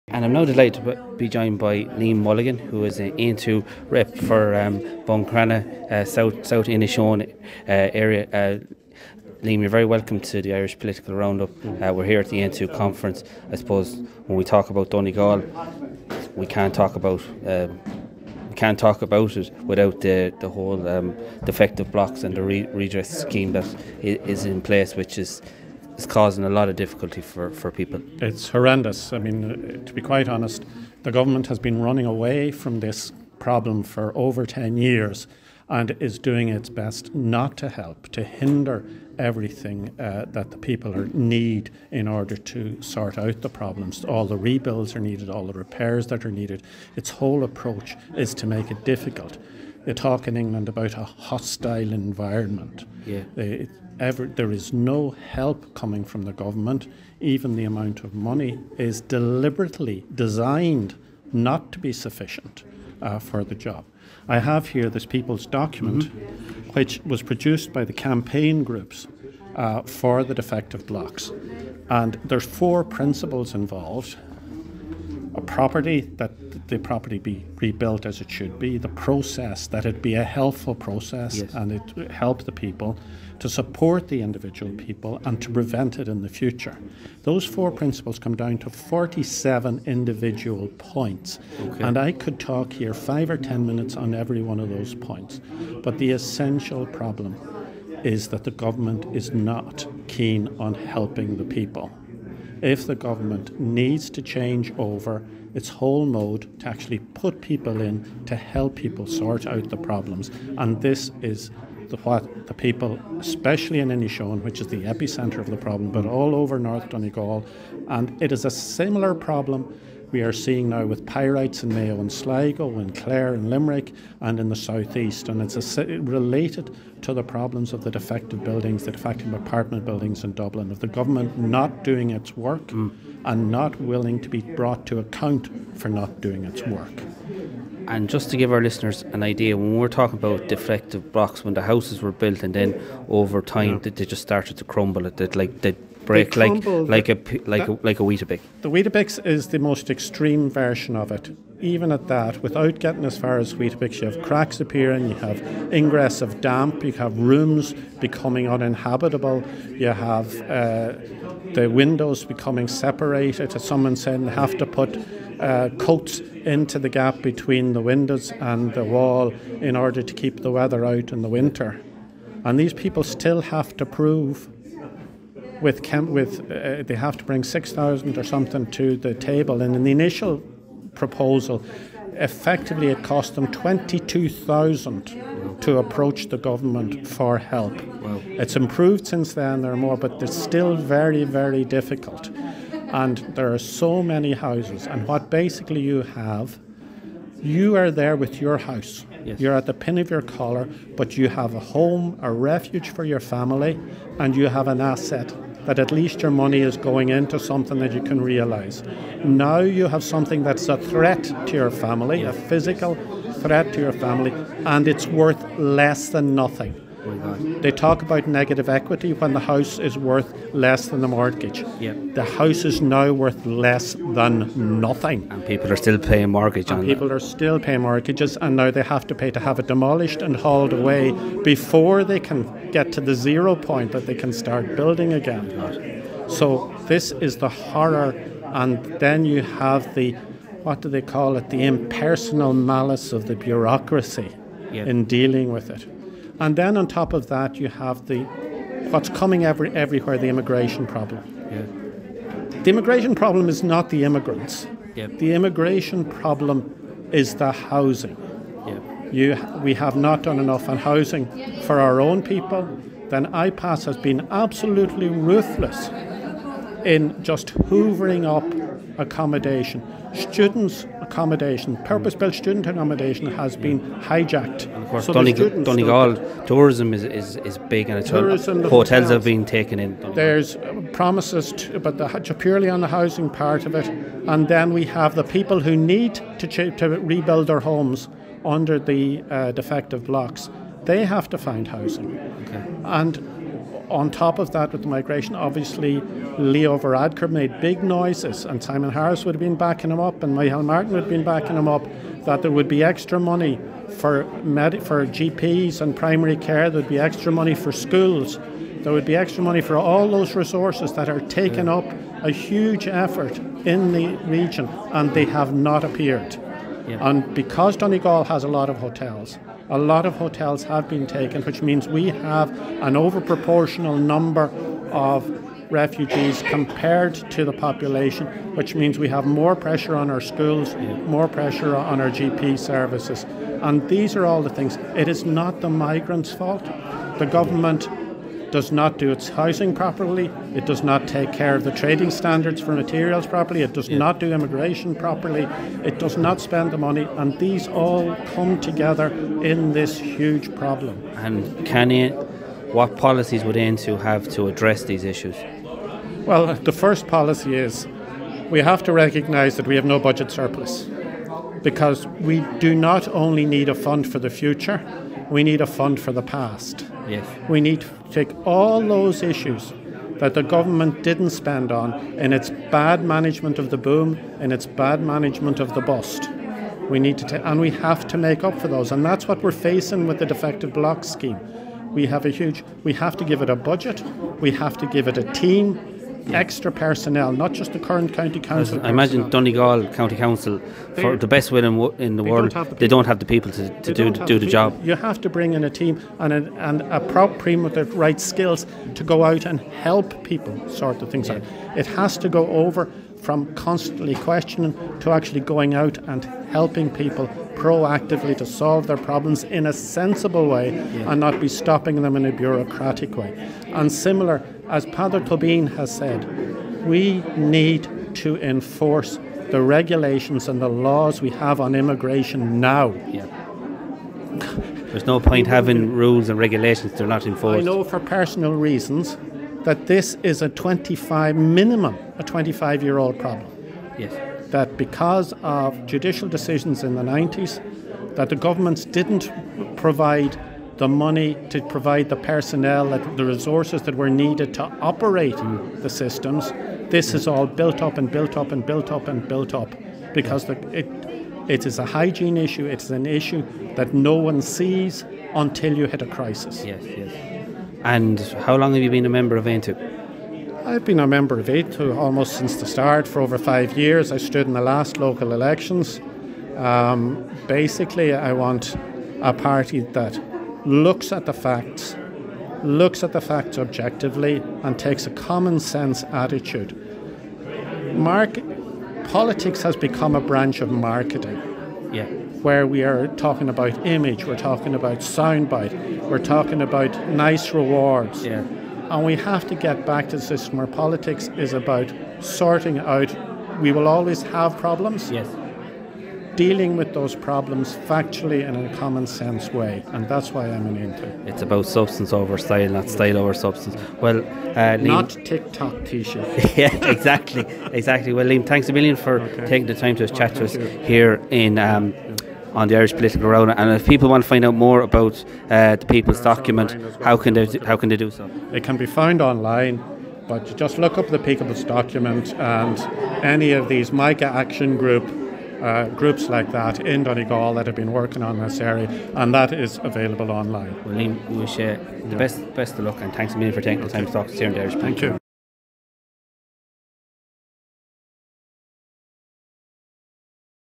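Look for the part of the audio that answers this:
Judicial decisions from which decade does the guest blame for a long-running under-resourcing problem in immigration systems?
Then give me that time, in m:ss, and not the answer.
7:17.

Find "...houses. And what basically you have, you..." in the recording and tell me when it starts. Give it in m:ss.
3:14.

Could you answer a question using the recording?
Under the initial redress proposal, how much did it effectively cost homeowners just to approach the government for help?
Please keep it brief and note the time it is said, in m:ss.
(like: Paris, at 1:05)
22,000, at 3:03.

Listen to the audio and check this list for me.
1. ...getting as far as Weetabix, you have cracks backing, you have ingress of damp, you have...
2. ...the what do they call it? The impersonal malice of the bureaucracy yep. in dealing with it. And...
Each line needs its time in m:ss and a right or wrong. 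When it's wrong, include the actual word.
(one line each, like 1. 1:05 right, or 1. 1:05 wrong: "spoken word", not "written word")
1. 2:32 wrong: "appearing", not "backing"
2. 3:59 right.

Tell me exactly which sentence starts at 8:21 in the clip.
It's about substance over style, not style over substance.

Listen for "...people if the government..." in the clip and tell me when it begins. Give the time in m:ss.
1:41.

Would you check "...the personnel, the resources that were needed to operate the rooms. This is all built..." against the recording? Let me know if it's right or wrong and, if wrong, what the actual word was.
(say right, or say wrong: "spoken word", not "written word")
wrong: "systems", not "rooms".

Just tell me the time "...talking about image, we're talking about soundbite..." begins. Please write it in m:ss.
8:03.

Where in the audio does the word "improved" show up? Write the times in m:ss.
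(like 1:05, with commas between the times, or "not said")
3:08.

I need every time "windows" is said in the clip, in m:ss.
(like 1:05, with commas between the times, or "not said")
2:41, 2:47.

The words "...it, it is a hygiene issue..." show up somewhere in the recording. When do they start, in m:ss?
7:30.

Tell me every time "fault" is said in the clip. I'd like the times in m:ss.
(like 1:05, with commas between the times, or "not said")
5:36.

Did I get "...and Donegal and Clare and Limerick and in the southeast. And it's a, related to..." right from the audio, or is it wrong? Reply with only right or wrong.
wrong.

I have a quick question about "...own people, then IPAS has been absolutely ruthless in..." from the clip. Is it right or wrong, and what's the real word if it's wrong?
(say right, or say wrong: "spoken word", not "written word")
right.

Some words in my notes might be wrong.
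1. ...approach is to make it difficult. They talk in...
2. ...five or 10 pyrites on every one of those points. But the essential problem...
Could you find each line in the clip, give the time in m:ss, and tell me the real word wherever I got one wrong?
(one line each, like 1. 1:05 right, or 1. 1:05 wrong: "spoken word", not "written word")
1. 0:47 right
2. 1:32 wrong: "minutes", not "pyrites".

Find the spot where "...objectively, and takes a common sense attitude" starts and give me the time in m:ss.
7:53.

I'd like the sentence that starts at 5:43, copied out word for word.
not do immigration properly, it does not spend the money, and these all come together in this huge problem.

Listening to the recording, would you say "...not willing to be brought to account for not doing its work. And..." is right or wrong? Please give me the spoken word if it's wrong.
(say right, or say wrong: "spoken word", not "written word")
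right.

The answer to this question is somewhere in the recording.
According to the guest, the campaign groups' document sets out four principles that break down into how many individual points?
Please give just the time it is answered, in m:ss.
1:28.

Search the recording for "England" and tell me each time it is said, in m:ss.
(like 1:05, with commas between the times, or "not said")
0:50.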